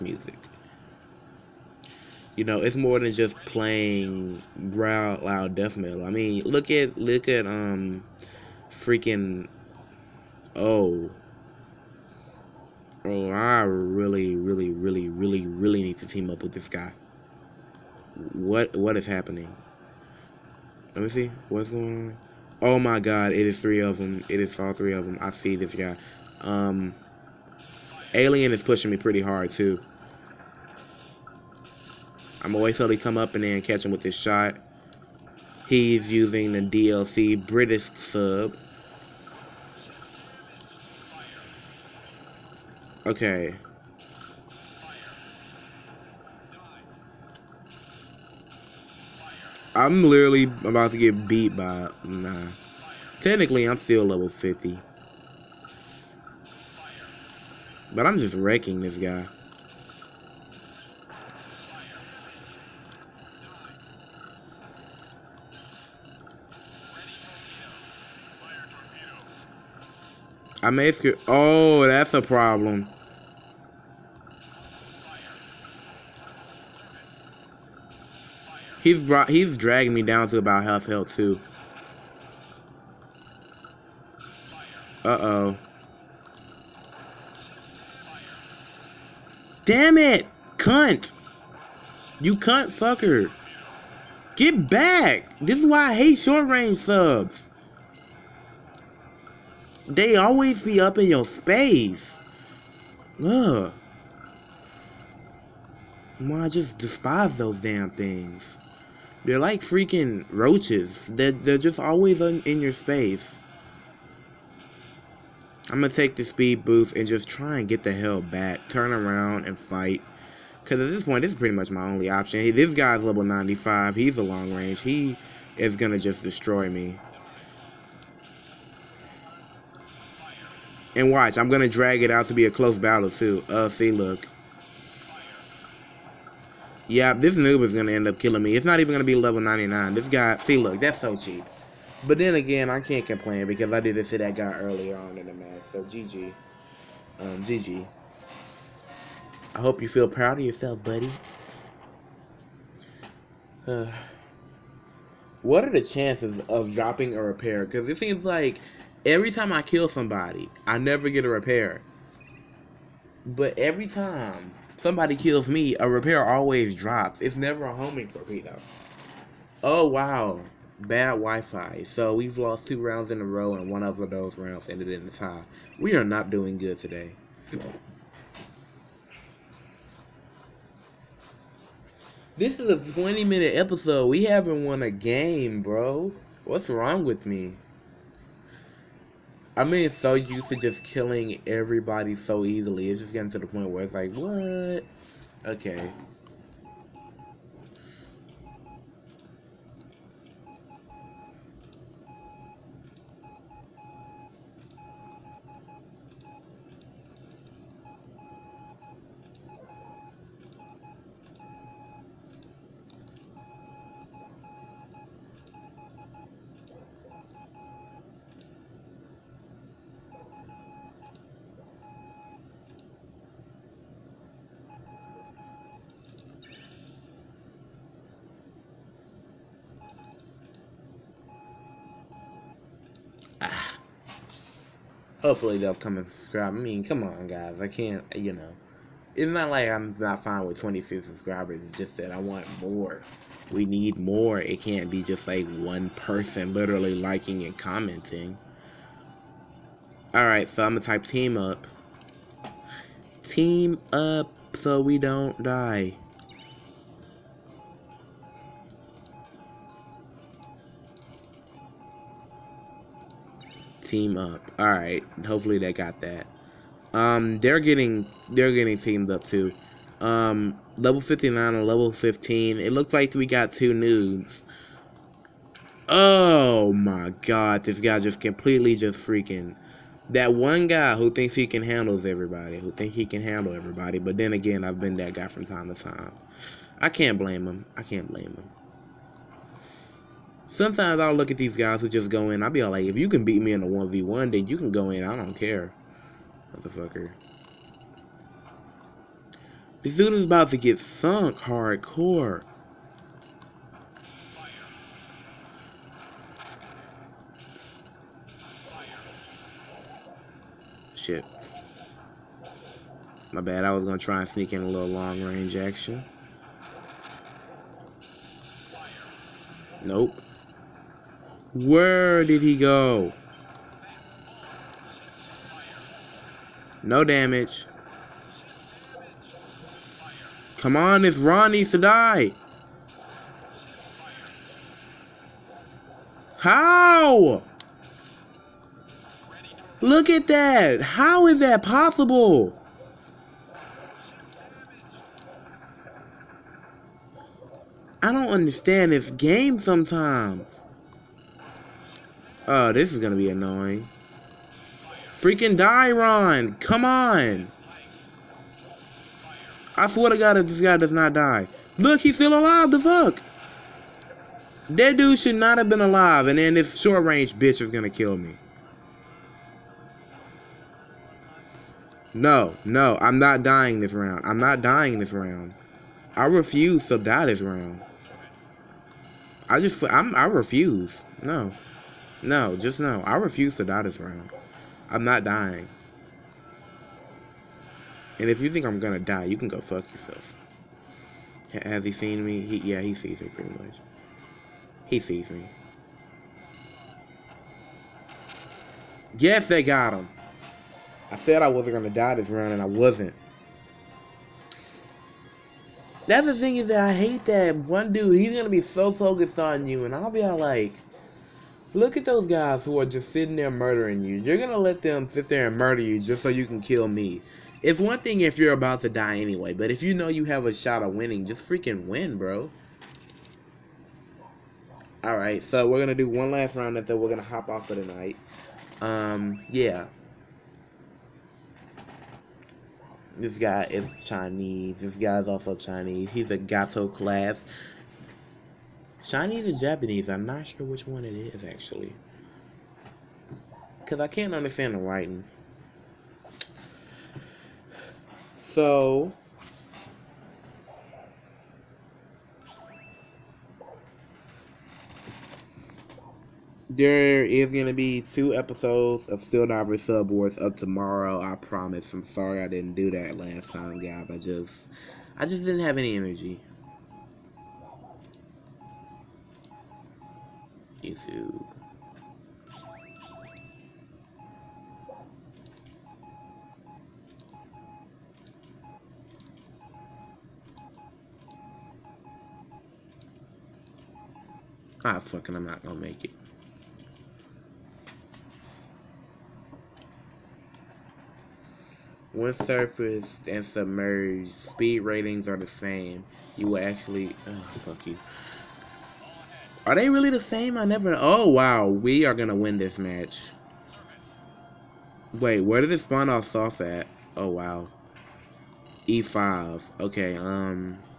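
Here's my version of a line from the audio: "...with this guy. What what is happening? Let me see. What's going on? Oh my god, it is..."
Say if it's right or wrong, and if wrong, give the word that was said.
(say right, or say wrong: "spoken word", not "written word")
right.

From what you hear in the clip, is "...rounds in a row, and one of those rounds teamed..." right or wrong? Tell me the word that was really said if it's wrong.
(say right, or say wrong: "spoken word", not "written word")
wrong: "ended", not "teamed".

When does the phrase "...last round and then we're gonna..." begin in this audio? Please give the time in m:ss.
7:06.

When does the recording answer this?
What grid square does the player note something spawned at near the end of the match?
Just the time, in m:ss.
8:28.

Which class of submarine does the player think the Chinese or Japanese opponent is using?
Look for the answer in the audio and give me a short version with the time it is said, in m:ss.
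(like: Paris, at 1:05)
Gato class, at 7:16.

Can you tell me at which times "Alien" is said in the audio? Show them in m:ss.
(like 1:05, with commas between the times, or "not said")
0:28.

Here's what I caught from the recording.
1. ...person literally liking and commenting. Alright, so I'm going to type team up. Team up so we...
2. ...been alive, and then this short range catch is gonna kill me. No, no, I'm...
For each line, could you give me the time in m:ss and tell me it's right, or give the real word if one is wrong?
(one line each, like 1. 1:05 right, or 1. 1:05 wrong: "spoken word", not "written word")
1. 4:05 right
2. 6:05 wrong: "bitch", not "catch".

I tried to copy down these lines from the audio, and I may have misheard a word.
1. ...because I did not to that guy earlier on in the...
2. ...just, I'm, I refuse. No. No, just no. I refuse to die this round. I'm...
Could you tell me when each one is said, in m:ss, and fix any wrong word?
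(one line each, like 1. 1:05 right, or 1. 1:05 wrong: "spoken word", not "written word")
1. 2:23 right
2. 6:19 right.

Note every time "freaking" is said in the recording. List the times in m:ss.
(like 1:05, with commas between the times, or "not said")
0:08, 1:49, 4:38, 5:54, 7:01.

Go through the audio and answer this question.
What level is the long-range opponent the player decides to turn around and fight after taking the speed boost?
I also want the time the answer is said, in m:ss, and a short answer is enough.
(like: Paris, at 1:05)
95, at 2:03.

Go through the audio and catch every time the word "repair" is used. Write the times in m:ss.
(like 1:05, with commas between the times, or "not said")
2:37, 2:41, 2:45.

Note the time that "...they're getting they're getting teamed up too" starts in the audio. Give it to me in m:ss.
4:27.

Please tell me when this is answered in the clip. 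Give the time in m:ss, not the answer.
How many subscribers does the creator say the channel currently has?
4:00.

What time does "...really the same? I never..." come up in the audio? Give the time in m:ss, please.
8:19.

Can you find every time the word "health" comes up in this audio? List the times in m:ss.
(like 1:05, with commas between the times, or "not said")
1:20.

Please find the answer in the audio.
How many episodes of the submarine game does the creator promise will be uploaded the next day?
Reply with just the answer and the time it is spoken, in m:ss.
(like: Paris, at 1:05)
2, at 7:38.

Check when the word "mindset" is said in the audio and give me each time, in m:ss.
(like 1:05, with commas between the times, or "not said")
not said.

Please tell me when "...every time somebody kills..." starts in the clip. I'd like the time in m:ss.
2:43.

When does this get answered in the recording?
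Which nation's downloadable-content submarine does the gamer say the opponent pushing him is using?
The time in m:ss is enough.
0:36.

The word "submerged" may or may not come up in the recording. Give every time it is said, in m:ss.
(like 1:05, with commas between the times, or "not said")
8:13.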